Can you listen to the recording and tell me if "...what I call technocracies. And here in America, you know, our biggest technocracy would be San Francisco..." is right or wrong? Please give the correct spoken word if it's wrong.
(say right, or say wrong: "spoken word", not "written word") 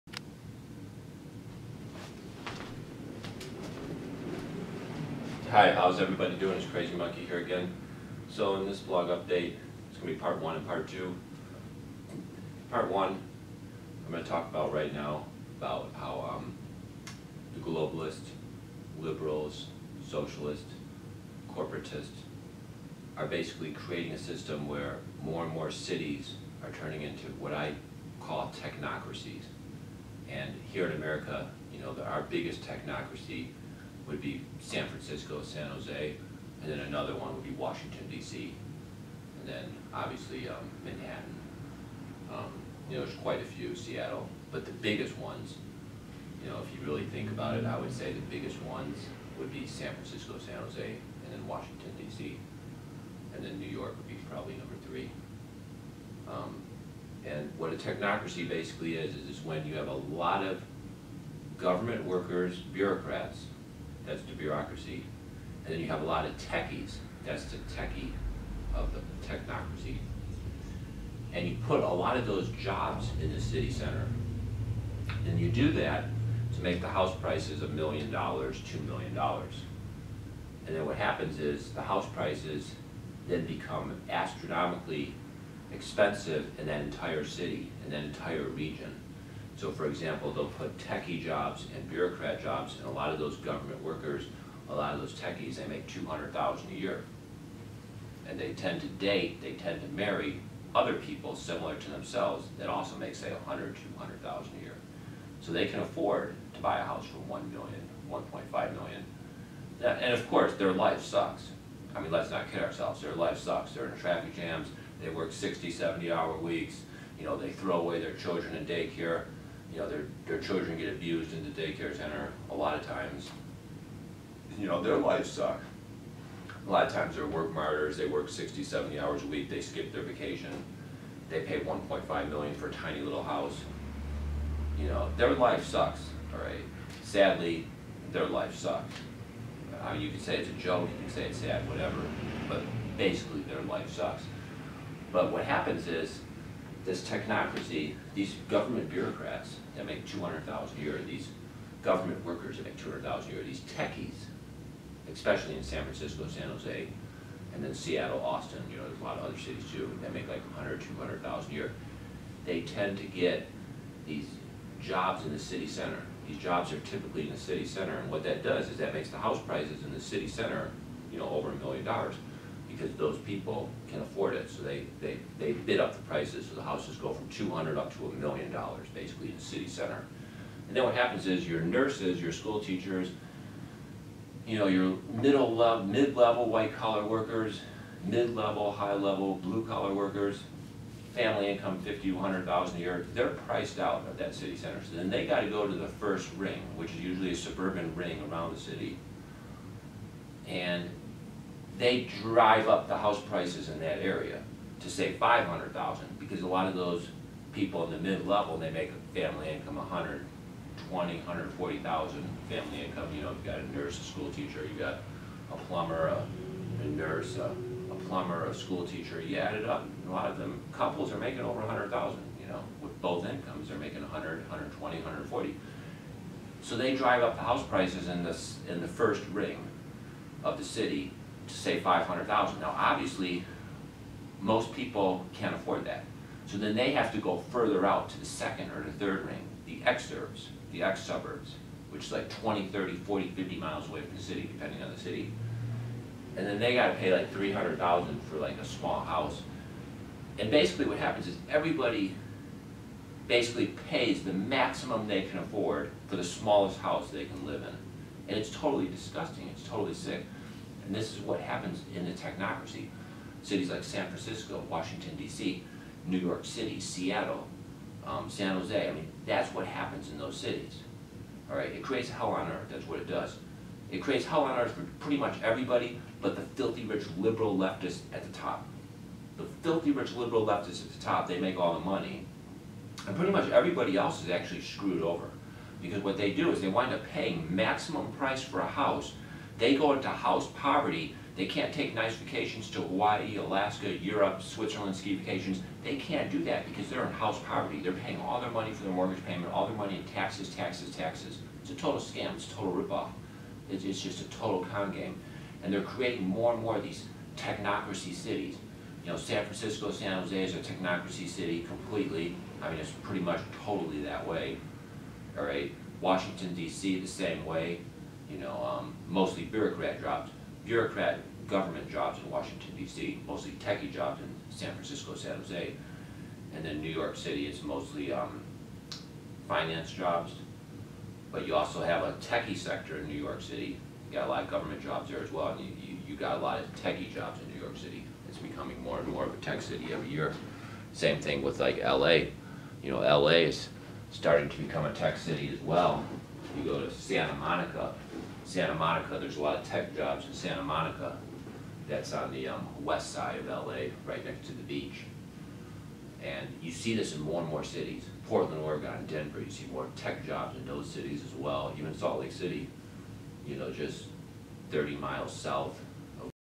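right.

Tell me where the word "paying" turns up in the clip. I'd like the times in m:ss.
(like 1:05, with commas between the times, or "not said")
4:47, 4:57.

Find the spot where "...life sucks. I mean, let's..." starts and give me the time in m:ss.
1:50.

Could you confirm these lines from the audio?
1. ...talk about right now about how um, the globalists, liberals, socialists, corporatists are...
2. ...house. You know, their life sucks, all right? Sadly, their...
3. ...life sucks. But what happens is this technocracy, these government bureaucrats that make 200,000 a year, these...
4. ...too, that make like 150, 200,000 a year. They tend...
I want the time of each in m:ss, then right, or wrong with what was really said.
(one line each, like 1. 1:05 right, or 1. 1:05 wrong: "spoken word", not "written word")
1. 0:14 right
2. 2:13 right
3. 2:23 right
4. 2:39 wrong: "100", not "150".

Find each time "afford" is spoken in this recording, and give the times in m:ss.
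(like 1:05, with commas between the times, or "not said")
1:45, 2:54, 3:55, 4:15.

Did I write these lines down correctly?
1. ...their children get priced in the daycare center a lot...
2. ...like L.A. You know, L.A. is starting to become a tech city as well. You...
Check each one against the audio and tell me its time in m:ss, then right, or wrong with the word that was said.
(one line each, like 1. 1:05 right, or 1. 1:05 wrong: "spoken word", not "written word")
1. 2:00 wrong: "abused", not "priced"
2. 5:41 right.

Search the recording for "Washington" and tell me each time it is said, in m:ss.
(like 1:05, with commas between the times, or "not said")
0:37, 0:51, 4:24, 5:16, 5:22.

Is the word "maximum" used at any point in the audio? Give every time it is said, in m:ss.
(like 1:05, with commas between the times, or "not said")
4:14, 4:47.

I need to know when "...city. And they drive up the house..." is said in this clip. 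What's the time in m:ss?
3:18.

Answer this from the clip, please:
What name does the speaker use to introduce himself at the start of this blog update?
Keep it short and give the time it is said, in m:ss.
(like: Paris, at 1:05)
Crazy Monkey, at 0:06.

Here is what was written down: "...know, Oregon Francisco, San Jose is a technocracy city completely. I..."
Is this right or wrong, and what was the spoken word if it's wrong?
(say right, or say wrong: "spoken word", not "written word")
wrong: "San", not "Oregon".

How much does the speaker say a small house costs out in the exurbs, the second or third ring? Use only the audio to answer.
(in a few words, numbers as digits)
300,000.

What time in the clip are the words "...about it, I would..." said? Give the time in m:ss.
0:47.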